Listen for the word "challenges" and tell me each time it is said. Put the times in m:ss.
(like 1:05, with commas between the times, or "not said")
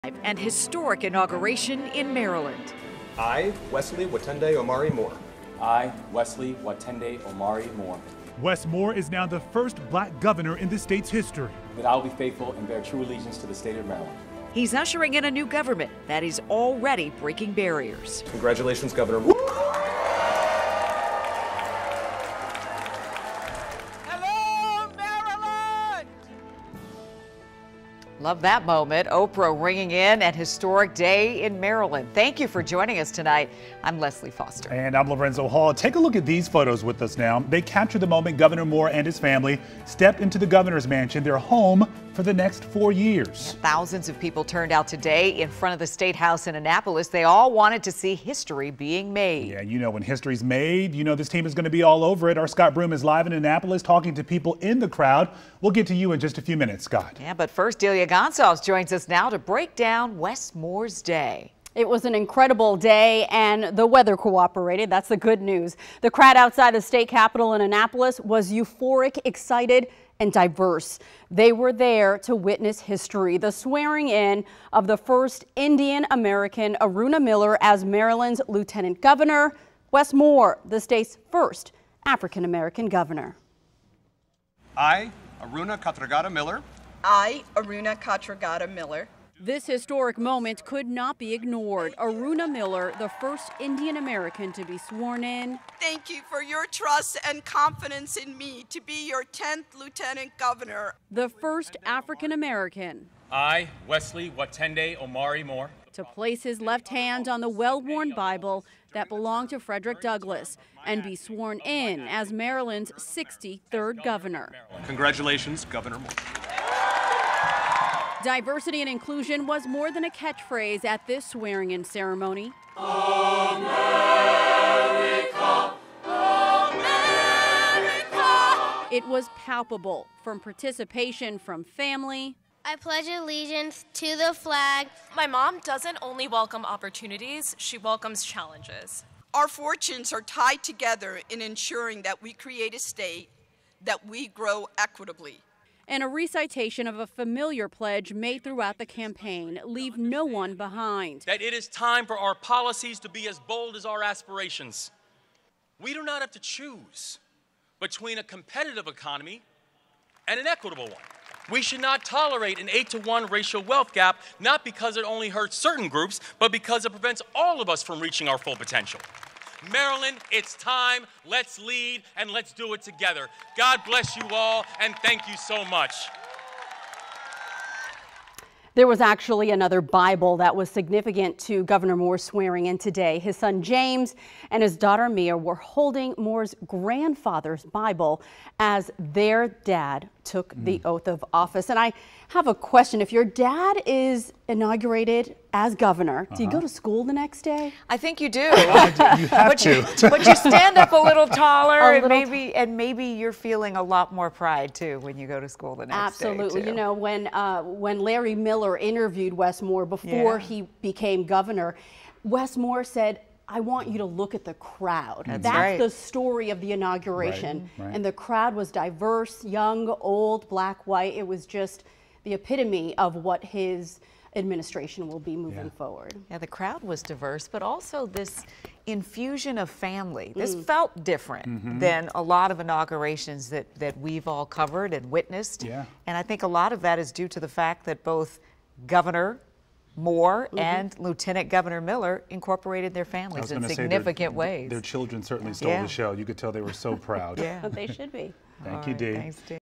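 2:18.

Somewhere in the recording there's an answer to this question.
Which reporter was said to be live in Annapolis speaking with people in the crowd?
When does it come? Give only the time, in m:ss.
0:52.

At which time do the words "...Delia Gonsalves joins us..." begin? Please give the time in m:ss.
0:57.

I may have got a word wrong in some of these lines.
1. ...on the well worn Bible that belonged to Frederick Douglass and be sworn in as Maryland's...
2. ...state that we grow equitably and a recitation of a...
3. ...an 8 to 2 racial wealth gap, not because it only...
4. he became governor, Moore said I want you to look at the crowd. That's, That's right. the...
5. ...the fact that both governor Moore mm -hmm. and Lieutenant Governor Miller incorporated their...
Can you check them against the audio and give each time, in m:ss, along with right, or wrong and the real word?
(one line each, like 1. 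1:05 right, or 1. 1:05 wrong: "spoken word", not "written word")
1. 1:47 right
2. 2:22 right
3. 2:42 wrong: "1", not "2"
4. 3:30 right
5. 3:57 right.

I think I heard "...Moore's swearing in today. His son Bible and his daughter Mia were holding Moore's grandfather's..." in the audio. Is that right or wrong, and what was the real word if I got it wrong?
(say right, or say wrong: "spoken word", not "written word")
wrong: "James", not "Bible".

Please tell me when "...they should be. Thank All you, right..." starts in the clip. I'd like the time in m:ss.
4:07.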